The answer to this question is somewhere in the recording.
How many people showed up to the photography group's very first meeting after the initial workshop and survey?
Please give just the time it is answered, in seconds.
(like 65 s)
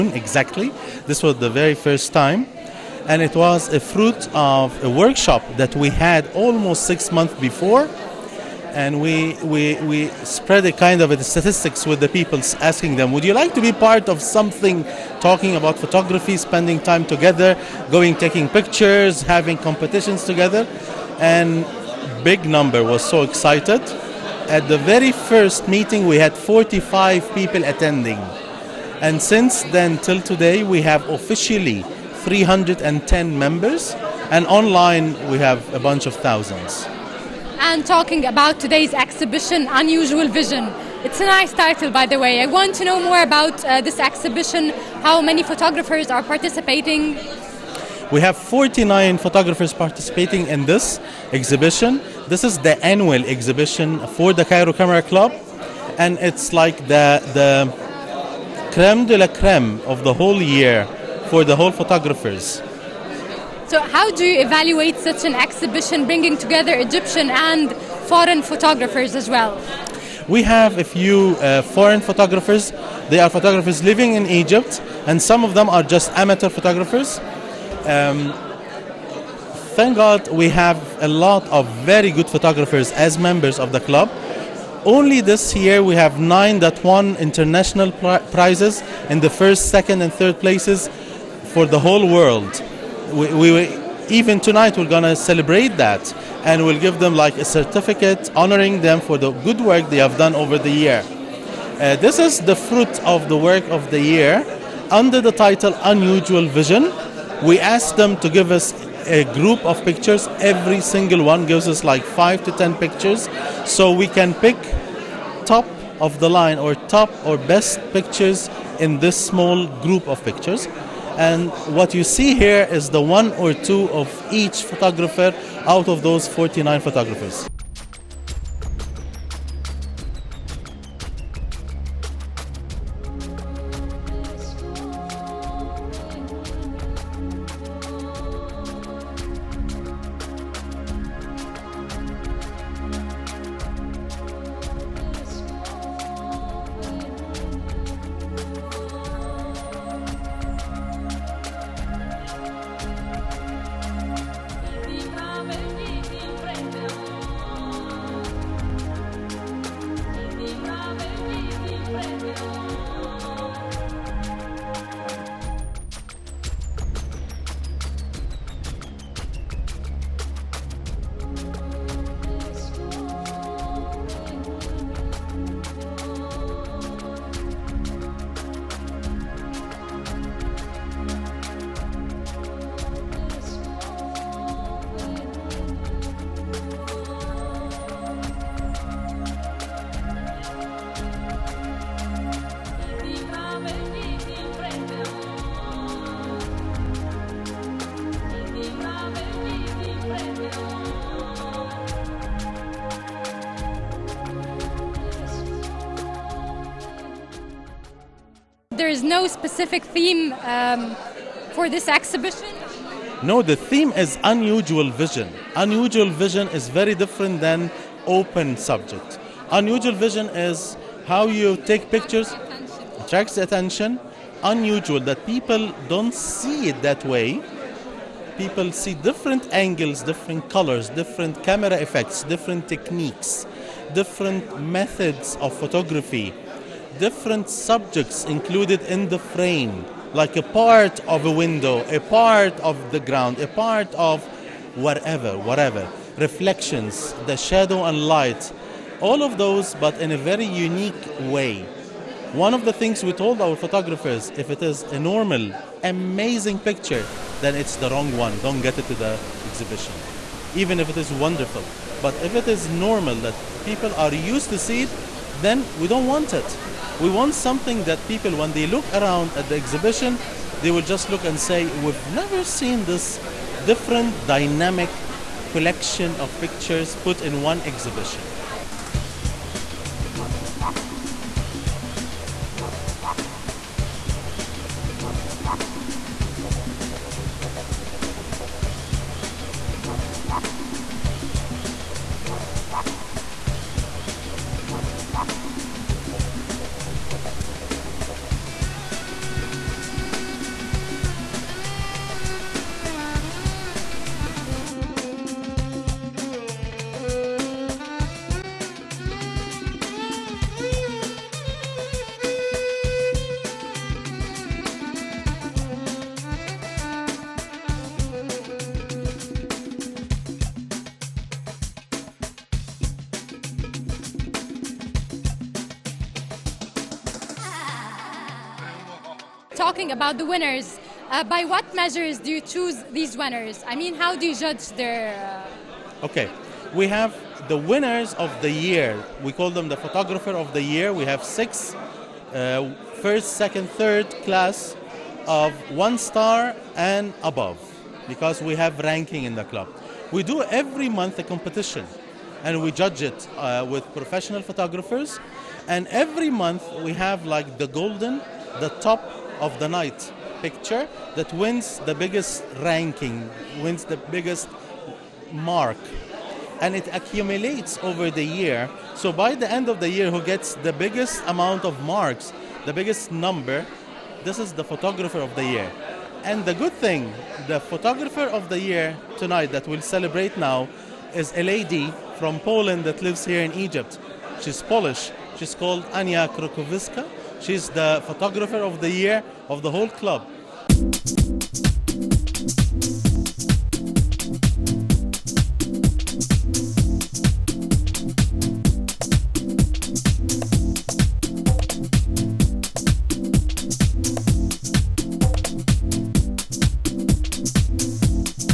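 26 s.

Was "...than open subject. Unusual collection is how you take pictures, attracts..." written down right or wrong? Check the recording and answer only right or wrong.
wrong.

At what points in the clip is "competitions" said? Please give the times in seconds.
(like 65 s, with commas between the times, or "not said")
19 s, 351 s.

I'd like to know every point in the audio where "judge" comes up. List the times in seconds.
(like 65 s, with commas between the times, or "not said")
334 s, 352 s.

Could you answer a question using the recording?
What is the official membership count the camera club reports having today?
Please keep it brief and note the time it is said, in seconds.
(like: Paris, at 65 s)
310, at 32 s.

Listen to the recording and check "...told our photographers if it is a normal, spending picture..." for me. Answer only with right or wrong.
wrong.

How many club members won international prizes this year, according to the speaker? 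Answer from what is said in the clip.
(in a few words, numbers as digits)
9.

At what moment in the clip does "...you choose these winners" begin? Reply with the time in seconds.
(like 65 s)
332 s.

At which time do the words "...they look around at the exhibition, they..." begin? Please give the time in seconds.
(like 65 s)
268 s.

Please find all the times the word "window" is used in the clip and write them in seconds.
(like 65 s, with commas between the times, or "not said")
241 s.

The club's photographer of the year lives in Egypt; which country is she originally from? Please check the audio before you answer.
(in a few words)
Poland.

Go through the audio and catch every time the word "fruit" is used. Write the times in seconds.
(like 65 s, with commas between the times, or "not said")
3 s, 102 s.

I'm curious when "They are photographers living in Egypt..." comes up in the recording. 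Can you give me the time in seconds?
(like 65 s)
73 s.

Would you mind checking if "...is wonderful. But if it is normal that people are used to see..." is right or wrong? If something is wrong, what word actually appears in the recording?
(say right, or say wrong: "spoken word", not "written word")
right.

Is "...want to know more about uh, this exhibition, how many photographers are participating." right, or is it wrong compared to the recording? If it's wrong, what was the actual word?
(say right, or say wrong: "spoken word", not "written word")
right.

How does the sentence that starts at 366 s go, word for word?
And it accumulates over the year.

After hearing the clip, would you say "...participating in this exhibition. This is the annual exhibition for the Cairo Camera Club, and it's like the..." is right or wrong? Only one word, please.
right.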